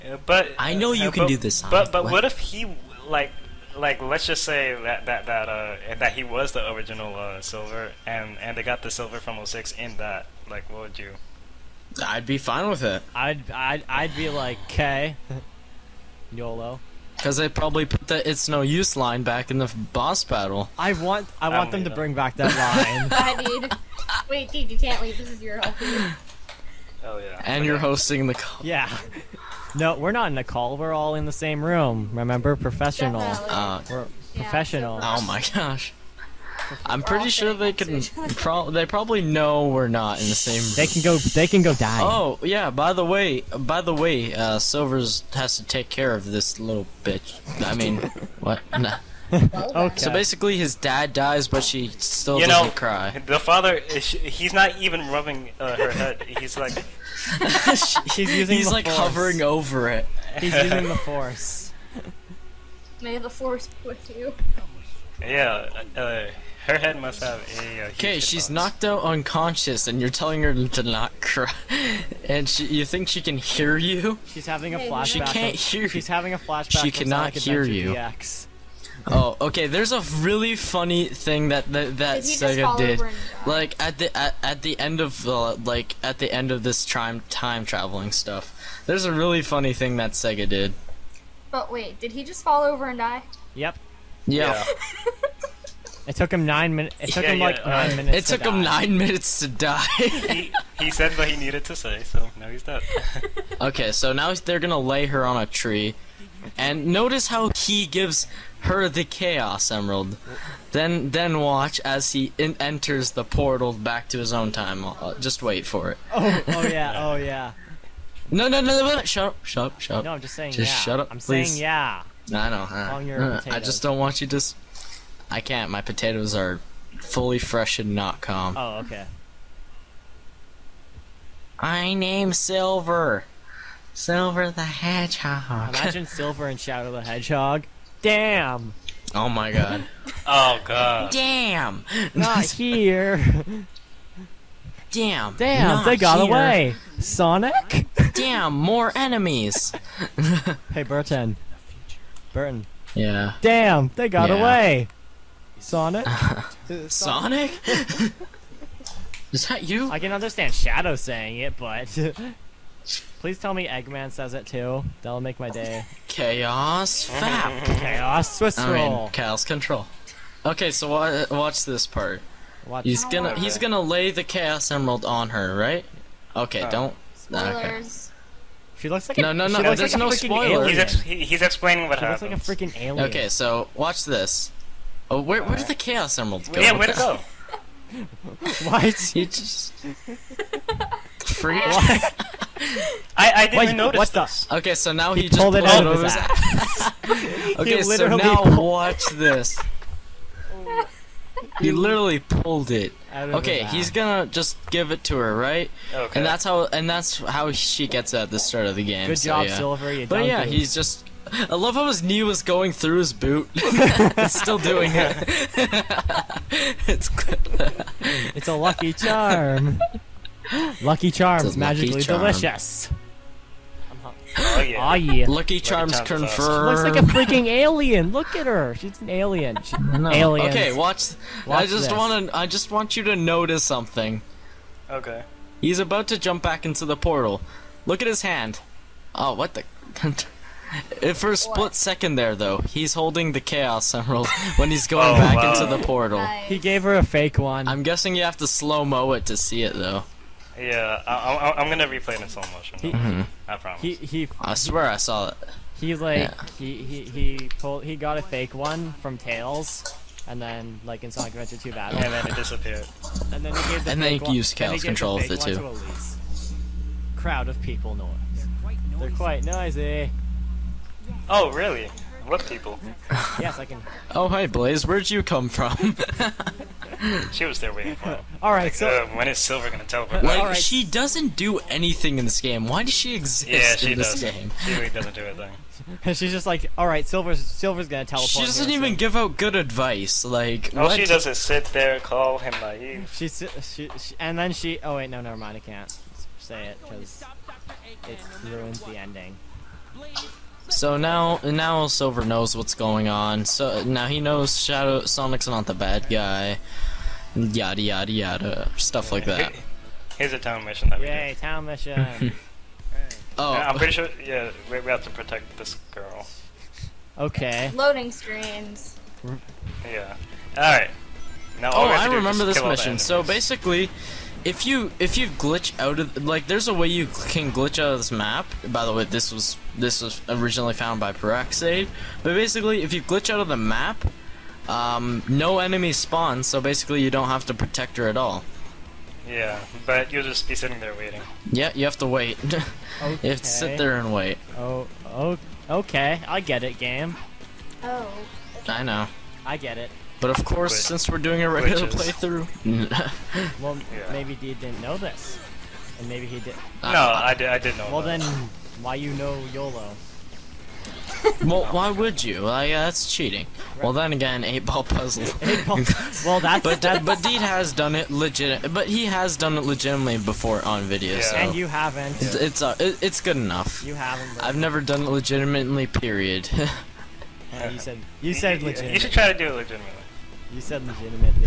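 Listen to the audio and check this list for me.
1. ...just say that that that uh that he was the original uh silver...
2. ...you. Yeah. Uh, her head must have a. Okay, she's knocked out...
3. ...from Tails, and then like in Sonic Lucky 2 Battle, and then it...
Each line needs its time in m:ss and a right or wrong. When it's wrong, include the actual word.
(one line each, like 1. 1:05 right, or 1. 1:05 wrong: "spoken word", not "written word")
1. 0:04 right
2. 1:04 right
3. 4:19 wrong: "Adventure", not "Lucky".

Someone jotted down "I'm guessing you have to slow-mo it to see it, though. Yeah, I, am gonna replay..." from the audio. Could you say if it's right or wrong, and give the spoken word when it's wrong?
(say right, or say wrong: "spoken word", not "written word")
right.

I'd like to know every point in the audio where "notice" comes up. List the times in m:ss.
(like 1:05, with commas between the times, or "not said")
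1:46, 3:13, 3:53.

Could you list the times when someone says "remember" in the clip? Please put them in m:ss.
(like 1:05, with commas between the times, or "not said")
0:32, 5:22.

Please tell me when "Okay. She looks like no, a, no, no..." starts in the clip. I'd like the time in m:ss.
2:58.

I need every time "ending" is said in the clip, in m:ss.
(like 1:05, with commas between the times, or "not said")
4:58.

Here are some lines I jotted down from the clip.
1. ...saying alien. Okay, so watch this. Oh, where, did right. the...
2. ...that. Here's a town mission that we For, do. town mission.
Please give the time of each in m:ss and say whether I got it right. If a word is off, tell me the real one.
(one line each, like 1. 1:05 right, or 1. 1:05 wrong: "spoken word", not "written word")
1. 3:02 wrong: "freaking", not "saying"
2. 5:09 wrong: "Yay", not "For".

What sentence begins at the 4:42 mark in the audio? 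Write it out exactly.
Why does she exist yeah, she in this does.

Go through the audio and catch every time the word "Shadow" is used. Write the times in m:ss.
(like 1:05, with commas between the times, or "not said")
2:16, 2:40, 5:04.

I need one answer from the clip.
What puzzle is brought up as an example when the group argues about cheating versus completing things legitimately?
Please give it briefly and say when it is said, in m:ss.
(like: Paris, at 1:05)
Eight ball puzzle, at 6:04.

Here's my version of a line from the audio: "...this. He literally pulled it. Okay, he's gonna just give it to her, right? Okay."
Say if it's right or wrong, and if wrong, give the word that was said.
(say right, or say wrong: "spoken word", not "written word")
right.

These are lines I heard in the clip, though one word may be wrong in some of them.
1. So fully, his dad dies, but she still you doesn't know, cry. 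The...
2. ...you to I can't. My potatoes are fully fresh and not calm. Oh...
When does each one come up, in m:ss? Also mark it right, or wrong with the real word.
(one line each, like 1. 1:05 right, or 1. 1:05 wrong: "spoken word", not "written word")
1. 0:49 wrong: "basically", not "fully"
2. 2:04 right.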